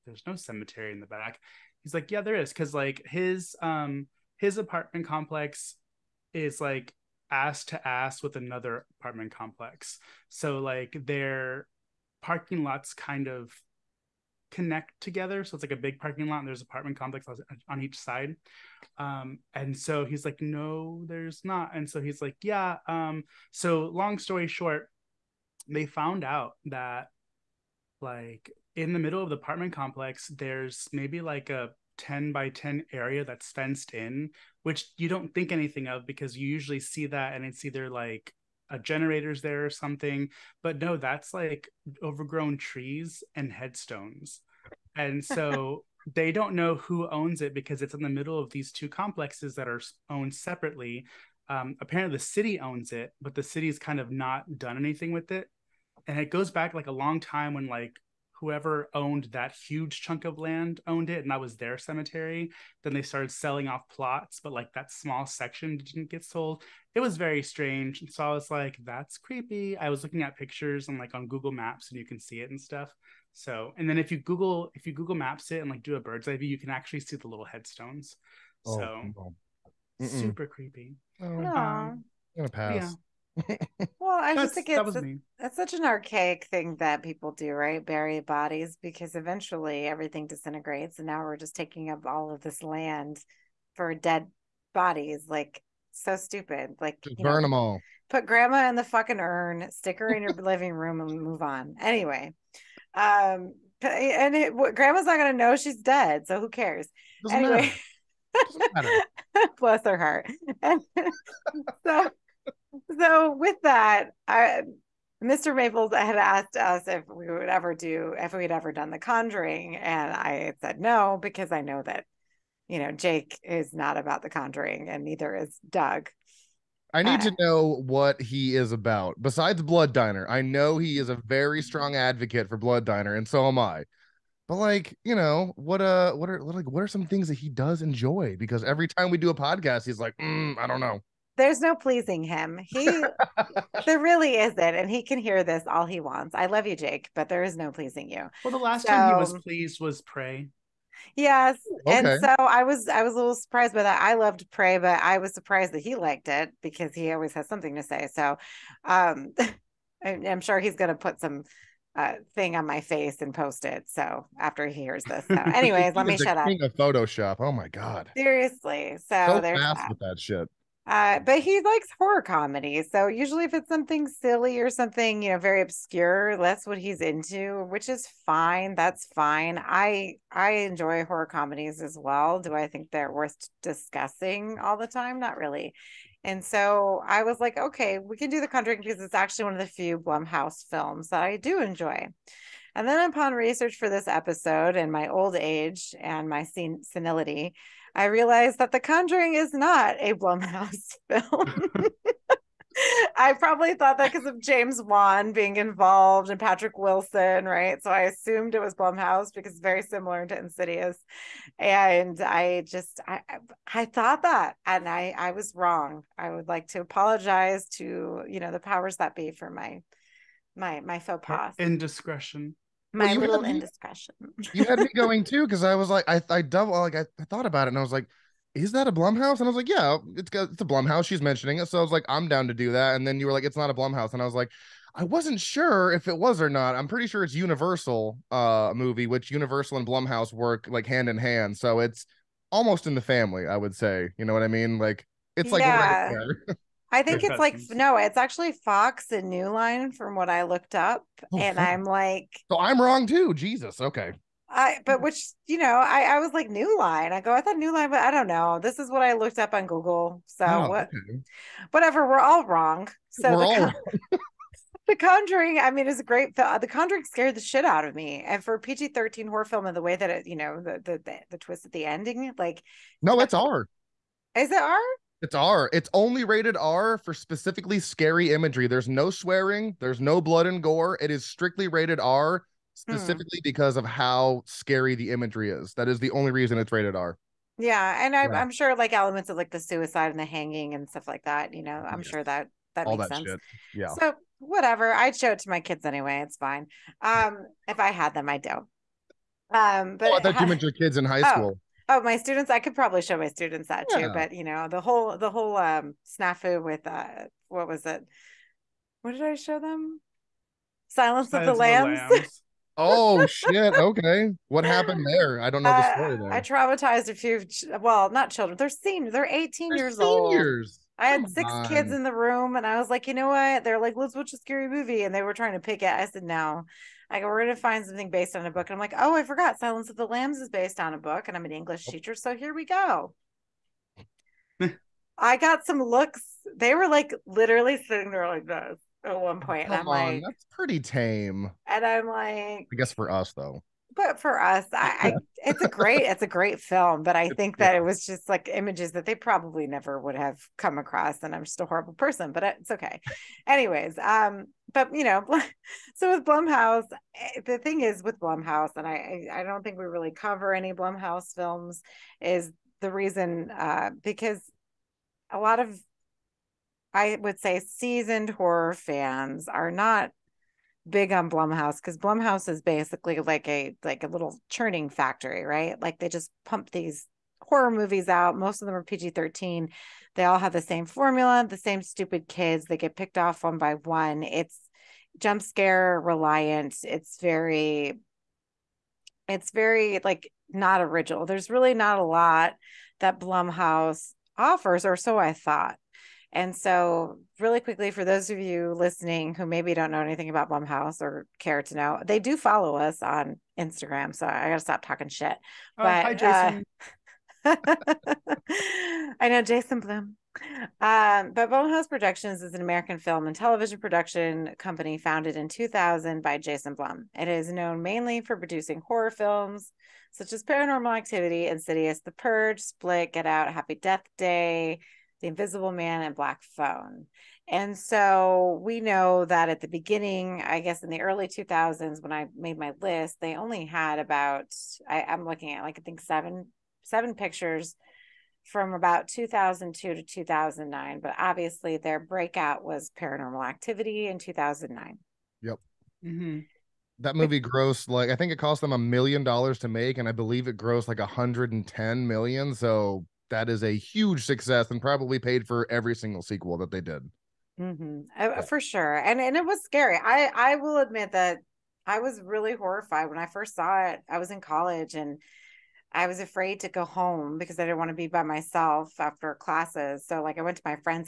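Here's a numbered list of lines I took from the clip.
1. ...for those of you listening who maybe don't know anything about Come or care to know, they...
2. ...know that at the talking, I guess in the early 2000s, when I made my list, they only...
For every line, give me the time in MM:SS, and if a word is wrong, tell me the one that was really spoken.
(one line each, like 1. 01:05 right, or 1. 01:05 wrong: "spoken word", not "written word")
1. 06:37 wrong: "Blumhouse", not "Come"
2. 07:08 wrong: "beginning", not "talking".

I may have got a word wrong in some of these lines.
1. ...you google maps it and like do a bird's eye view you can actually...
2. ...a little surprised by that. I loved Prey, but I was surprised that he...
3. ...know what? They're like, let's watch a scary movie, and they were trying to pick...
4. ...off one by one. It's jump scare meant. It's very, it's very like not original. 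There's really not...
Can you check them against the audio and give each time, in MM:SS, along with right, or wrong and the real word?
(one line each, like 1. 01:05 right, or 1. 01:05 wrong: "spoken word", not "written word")
1. 01:14 right
2. 02:33 right
3. 05:23 right
4. 06:23 wrong: "reliant", not "meant".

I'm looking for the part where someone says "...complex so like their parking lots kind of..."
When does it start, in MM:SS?
00:09.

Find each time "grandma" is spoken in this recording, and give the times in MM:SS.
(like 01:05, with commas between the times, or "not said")
01:38, 01:44.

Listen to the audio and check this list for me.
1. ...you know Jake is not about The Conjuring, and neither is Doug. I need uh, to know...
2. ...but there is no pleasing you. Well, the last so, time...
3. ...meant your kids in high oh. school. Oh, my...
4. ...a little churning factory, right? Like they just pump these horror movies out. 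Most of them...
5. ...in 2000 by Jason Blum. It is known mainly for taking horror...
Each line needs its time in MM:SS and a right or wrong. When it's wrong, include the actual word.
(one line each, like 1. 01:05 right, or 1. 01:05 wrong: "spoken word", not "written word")
1. 02:02 right
2. 02:27 right
3. 05:00 right
4. 06:14 right
5. 06:55 wrong: "producing", not "taking".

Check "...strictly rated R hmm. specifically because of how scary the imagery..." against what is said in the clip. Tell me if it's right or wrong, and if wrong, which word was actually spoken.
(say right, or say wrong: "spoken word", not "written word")
right.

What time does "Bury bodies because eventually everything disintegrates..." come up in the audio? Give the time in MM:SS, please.
01:27.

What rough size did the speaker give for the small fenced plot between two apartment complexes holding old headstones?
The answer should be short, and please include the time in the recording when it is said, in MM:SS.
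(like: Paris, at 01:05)
10 by 10, at 00:31.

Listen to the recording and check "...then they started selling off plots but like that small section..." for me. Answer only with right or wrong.
right.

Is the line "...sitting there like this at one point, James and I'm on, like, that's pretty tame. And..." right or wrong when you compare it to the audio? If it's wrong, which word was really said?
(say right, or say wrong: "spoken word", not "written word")
wrong: "Come", not "James".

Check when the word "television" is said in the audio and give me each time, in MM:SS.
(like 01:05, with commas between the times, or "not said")
06:53.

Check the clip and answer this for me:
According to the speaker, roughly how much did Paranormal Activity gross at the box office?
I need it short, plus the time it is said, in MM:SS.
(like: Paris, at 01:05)
110 million dollars, at 07:30.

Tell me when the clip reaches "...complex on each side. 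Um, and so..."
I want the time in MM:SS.
00:16.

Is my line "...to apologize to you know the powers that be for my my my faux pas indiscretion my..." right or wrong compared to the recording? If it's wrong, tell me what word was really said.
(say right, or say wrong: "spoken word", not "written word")
right.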